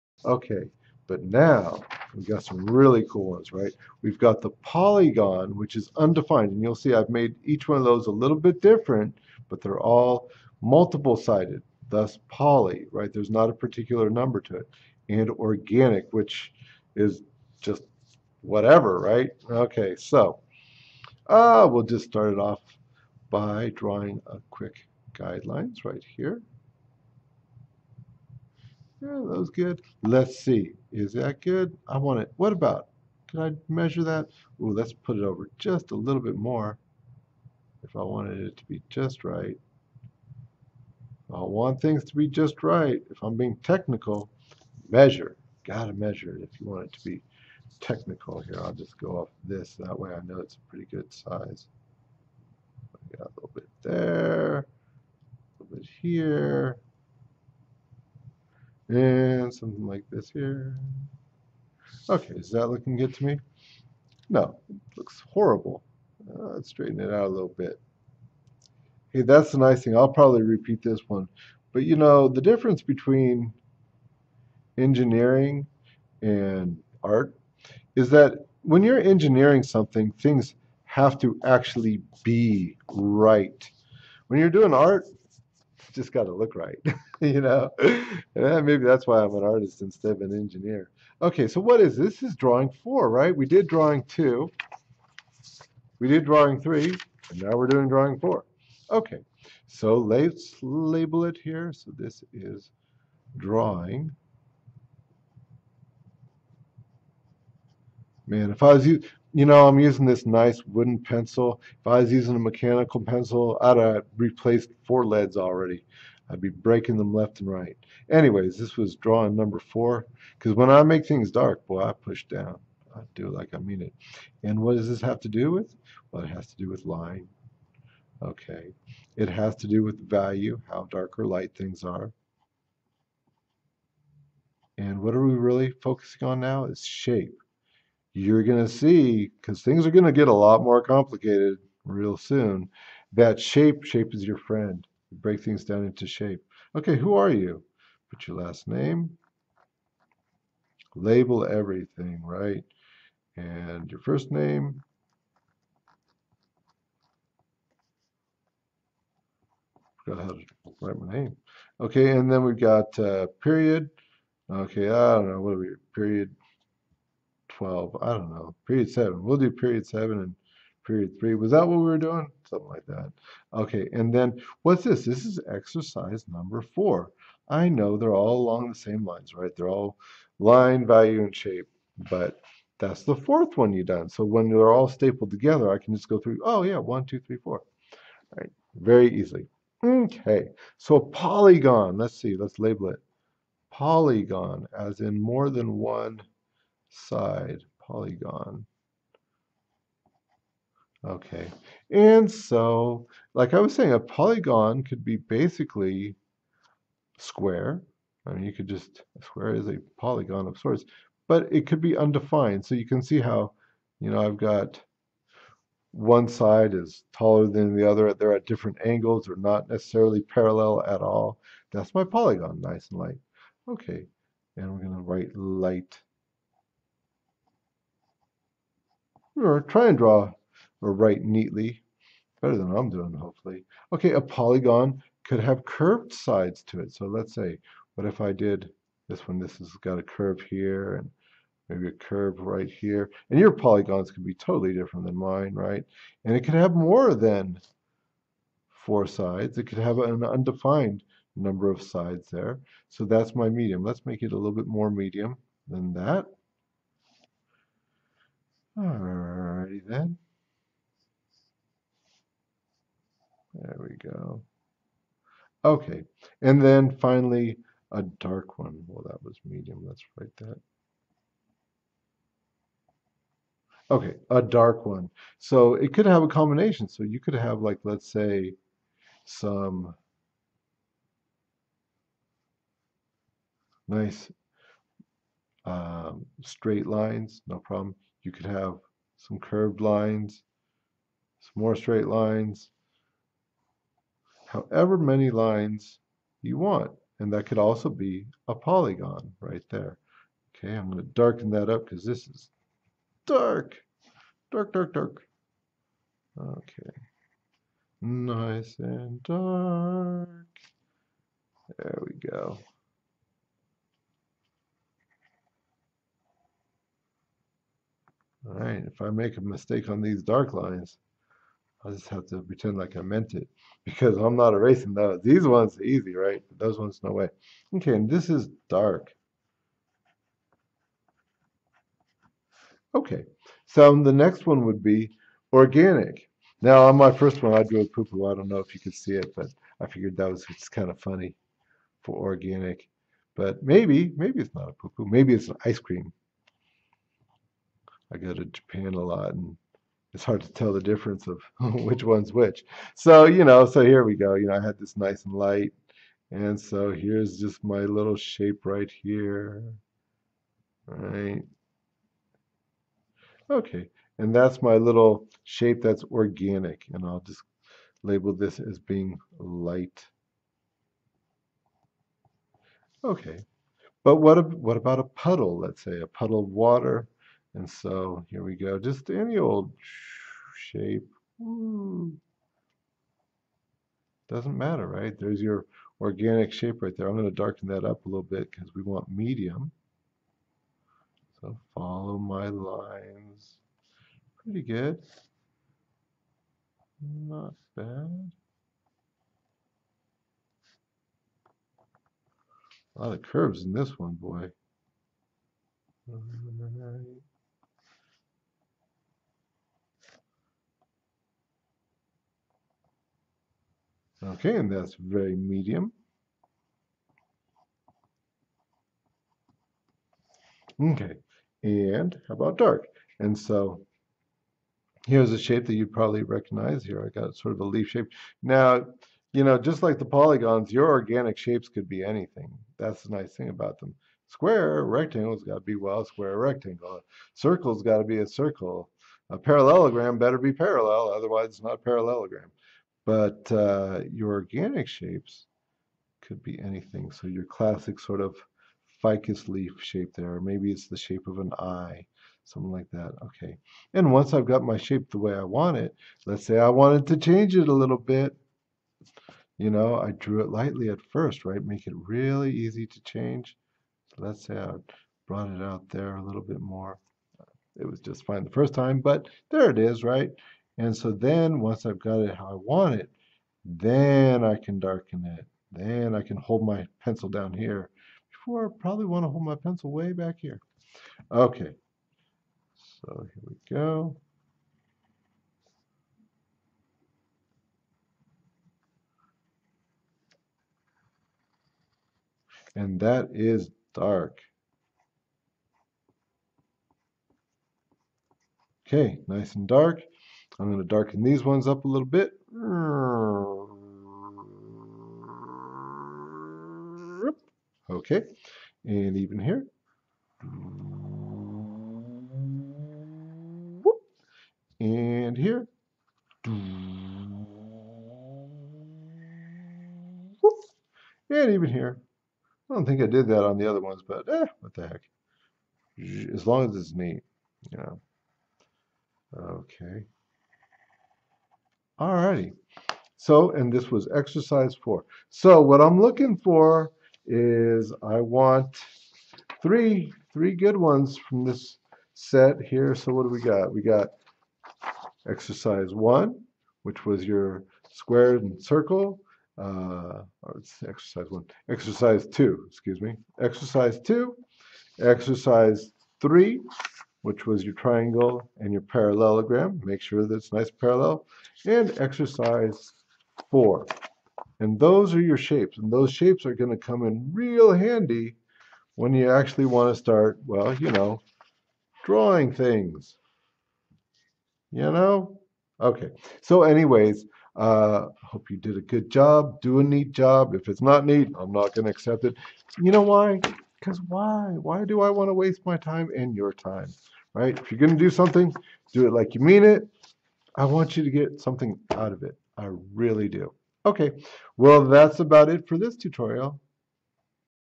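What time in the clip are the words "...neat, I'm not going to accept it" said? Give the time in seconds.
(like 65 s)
581 s.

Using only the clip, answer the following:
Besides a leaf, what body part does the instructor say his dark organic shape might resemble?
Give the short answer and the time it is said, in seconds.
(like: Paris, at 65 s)
An eye, at 451 s.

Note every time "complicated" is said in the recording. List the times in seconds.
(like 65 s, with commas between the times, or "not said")
140 s.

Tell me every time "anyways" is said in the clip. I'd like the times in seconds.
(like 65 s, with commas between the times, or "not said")
118 s, 576 s.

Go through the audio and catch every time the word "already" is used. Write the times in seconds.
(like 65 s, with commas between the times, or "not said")
115 s.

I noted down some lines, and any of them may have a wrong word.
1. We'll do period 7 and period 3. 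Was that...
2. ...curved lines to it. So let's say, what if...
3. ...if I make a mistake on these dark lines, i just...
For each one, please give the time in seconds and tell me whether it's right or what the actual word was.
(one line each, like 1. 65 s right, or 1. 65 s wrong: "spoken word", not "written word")
1. 169 s right
2. 235 s wrong: "sides", not "lines"
3. 318 s right.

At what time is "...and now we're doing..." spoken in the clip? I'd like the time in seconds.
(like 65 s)
97 s.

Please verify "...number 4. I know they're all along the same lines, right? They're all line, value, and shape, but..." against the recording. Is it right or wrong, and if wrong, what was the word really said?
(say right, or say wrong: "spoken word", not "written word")
right.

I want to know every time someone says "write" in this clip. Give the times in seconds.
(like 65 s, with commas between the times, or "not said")
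160 s, 225 s, 230 s, 270 s.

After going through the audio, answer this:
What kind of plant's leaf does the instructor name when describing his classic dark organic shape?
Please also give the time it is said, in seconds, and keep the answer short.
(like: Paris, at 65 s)
Ficus, at 449 s.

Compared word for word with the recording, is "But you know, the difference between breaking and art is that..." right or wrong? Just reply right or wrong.
wrong.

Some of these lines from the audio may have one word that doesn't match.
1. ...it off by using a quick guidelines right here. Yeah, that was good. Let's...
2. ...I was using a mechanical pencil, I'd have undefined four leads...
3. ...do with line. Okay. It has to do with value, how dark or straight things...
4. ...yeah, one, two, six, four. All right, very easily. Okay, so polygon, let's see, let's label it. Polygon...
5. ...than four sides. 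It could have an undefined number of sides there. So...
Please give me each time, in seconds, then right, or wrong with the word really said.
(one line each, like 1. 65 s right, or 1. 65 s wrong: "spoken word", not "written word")
1. 22 s wrong: "drawing", not "using"
2. 111 s wrong: "replaced", not "undefined"
3. 126 s wrong: "light", not "straight"
4. 186 s wrong: "three", not "six"
5. 247 s right.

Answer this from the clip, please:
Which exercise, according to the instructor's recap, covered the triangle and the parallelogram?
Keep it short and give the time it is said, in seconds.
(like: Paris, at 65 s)
Exercise 3, at 554 s.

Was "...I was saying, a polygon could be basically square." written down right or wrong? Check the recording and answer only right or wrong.
right.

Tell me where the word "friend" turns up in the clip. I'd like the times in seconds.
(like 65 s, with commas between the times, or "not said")
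144 s.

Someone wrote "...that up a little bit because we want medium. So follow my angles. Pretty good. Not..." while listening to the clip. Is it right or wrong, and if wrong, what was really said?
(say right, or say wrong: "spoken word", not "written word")
wrong: "lines", not "angles".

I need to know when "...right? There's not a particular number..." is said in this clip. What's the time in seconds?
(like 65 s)
12 s.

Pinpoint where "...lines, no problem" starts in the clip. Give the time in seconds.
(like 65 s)
286 s.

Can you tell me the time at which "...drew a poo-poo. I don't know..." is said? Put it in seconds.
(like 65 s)
337 s.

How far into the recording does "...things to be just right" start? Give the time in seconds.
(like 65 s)
41 s.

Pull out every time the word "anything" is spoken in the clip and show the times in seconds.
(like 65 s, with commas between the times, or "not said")
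432 s, 446 s.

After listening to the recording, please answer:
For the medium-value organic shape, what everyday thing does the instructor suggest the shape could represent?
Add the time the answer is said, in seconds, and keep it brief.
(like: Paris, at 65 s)
A puddle of water, at 376 s.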